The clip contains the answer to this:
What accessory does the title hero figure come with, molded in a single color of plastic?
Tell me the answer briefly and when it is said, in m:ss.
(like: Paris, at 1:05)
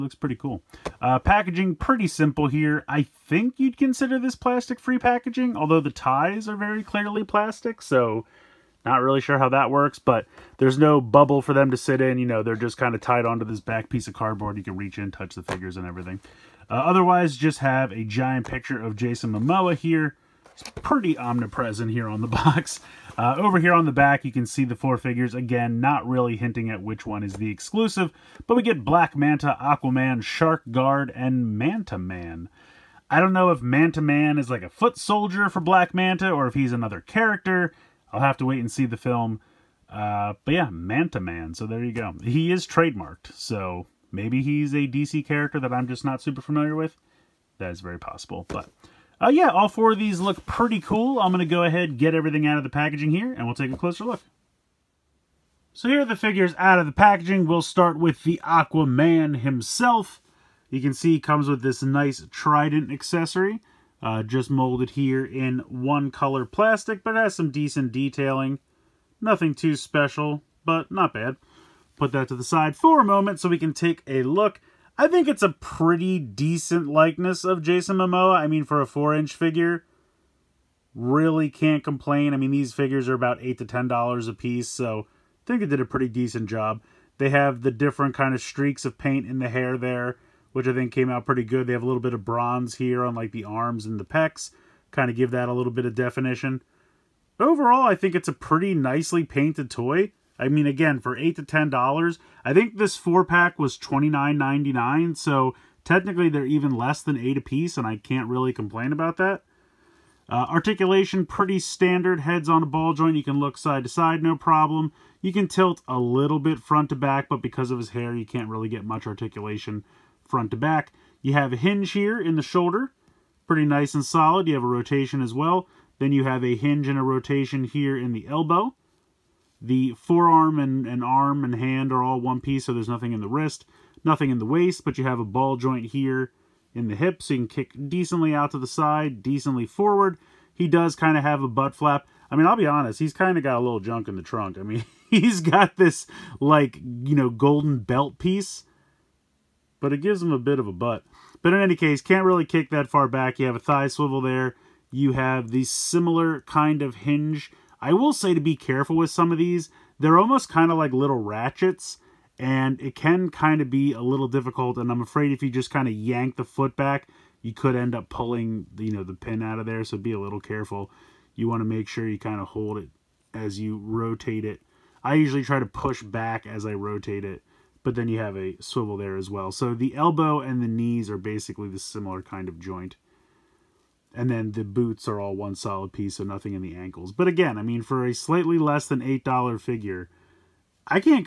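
Trident, at 1:02.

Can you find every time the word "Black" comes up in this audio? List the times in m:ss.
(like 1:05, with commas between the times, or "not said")
0:28, 0:35.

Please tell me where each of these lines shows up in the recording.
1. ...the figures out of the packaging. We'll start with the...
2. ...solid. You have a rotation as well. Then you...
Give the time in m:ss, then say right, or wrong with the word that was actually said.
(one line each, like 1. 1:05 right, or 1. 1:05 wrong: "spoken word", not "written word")
1. 0:56 right
2. 2:04 right.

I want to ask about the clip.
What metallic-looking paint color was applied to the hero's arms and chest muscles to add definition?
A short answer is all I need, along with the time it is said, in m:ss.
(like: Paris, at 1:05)
Bronze, at 1:32.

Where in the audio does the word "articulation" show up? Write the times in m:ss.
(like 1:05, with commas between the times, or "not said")
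1:50, 1:59.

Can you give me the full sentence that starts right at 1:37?
Overall, I think it's a pretty nicely painted toy.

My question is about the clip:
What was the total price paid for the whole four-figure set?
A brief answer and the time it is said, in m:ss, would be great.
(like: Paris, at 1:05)
$29.99, at 1:43.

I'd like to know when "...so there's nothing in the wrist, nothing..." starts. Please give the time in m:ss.
2:12.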